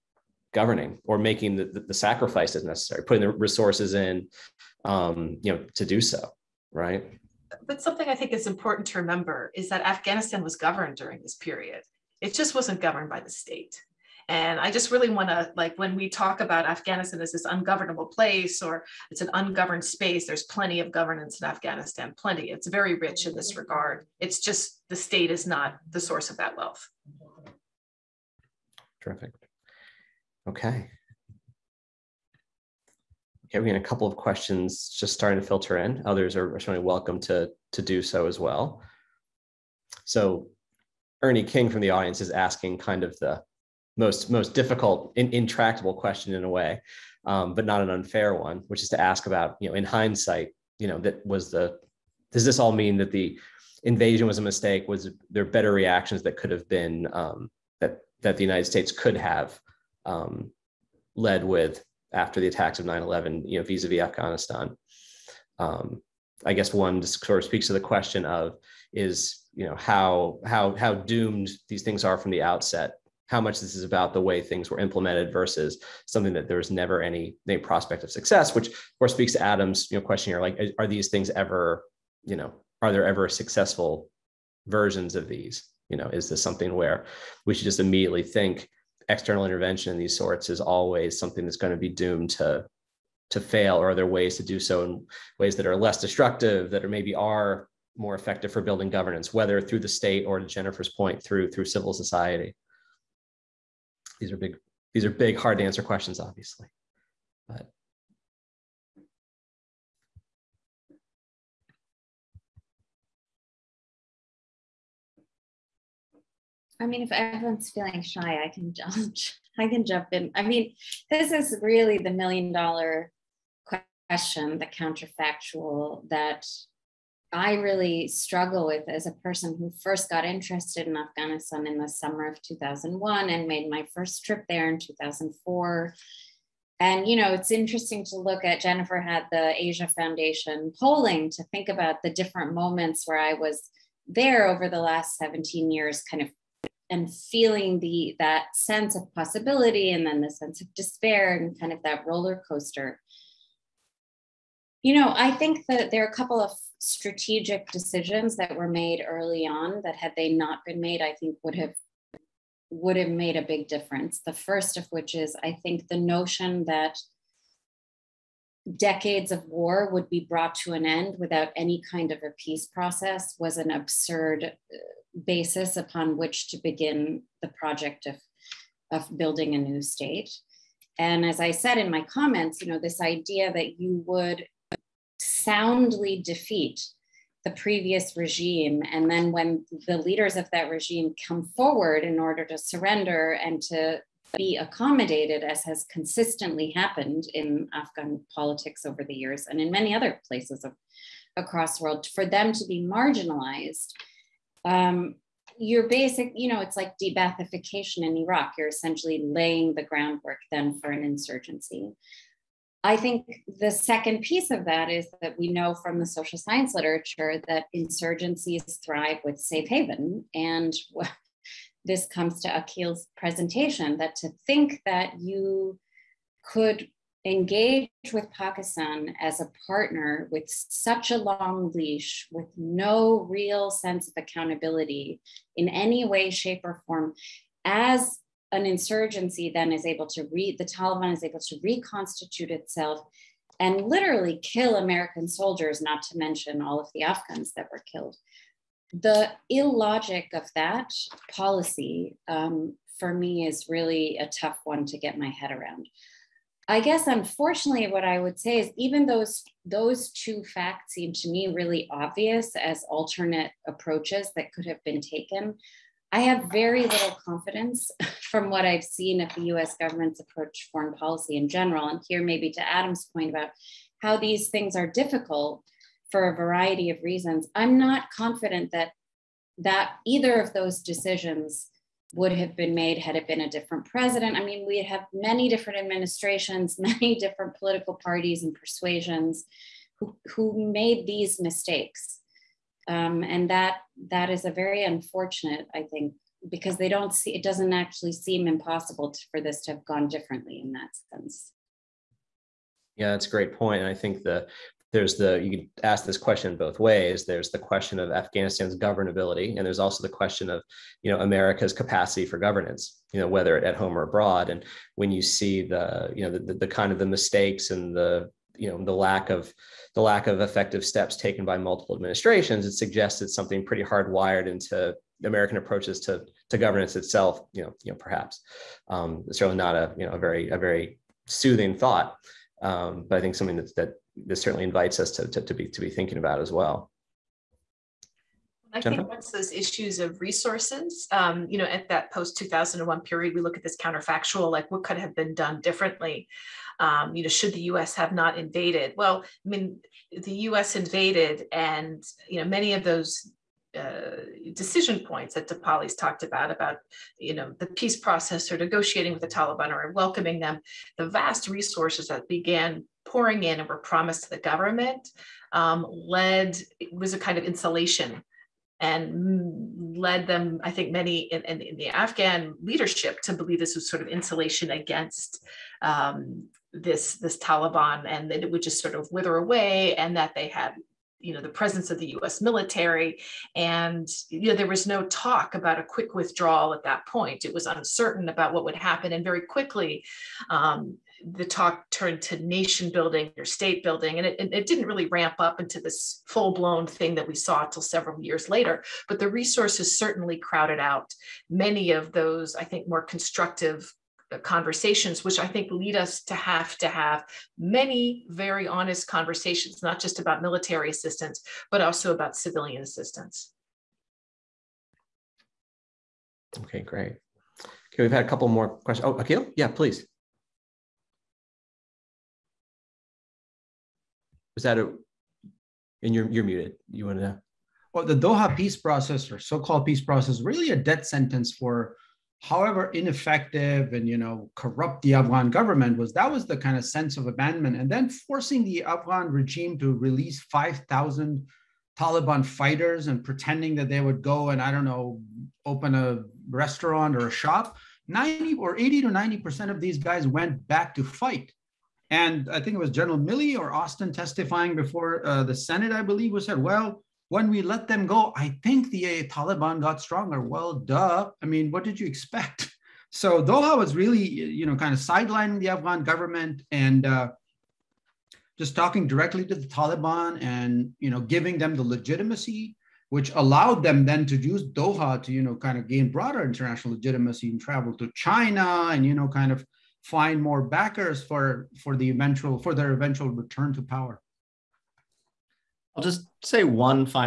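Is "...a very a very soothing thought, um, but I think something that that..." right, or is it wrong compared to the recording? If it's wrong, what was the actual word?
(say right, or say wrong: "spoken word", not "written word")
right.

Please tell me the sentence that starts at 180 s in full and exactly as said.
And as I said in my comments, you know, this idea that you would soundly defeat the previous regime.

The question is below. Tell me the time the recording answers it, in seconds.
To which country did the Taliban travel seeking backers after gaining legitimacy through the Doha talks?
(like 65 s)
478 s.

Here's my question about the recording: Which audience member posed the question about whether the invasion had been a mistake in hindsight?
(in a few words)
Ernie King.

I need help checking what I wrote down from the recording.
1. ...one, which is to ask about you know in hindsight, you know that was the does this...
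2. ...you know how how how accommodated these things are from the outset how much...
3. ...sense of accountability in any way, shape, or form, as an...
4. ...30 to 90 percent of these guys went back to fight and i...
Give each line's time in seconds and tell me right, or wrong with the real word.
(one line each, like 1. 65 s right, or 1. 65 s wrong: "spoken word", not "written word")
1. 48 s right
2. 69 s wrong: "doomed", not "accommodated"
3. 233 s right
4. 448 s wrong: "80", not "30".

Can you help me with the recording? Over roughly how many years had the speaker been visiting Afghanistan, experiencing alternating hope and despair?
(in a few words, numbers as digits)
17.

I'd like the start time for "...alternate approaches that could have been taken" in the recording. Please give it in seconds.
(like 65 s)
262 s.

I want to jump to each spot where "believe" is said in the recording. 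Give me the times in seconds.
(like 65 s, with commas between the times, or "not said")
373 s, 456 s.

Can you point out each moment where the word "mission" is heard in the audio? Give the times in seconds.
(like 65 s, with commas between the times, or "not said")
not said.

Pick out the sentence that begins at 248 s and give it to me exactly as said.
The illogic of that policy um, for me is really a tough one to get my head around.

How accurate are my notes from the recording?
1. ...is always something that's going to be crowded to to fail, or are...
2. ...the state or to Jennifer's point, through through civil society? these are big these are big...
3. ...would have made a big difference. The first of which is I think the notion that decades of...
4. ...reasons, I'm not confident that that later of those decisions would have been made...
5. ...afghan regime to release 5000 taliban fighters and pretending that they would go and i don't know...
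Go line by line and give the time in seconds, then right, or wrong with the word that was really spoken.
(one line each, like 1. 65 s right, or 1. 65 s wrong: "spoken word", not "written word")
1. 90 s wrong: "doomed", not "crowded"
2. 99 s right
3. 162 s right
4. 277 s wrong: "either", not "later"
5. 438 s right.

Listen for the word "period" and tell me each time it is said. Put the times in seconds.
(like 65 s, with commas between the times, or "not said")
11 s, 343 s.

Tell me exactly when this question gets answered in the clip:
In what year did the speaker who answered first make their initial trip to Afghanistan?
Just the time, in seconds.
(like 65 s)
134 s.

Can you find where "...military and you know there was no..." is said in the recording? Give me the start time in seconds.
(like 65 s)
382 s.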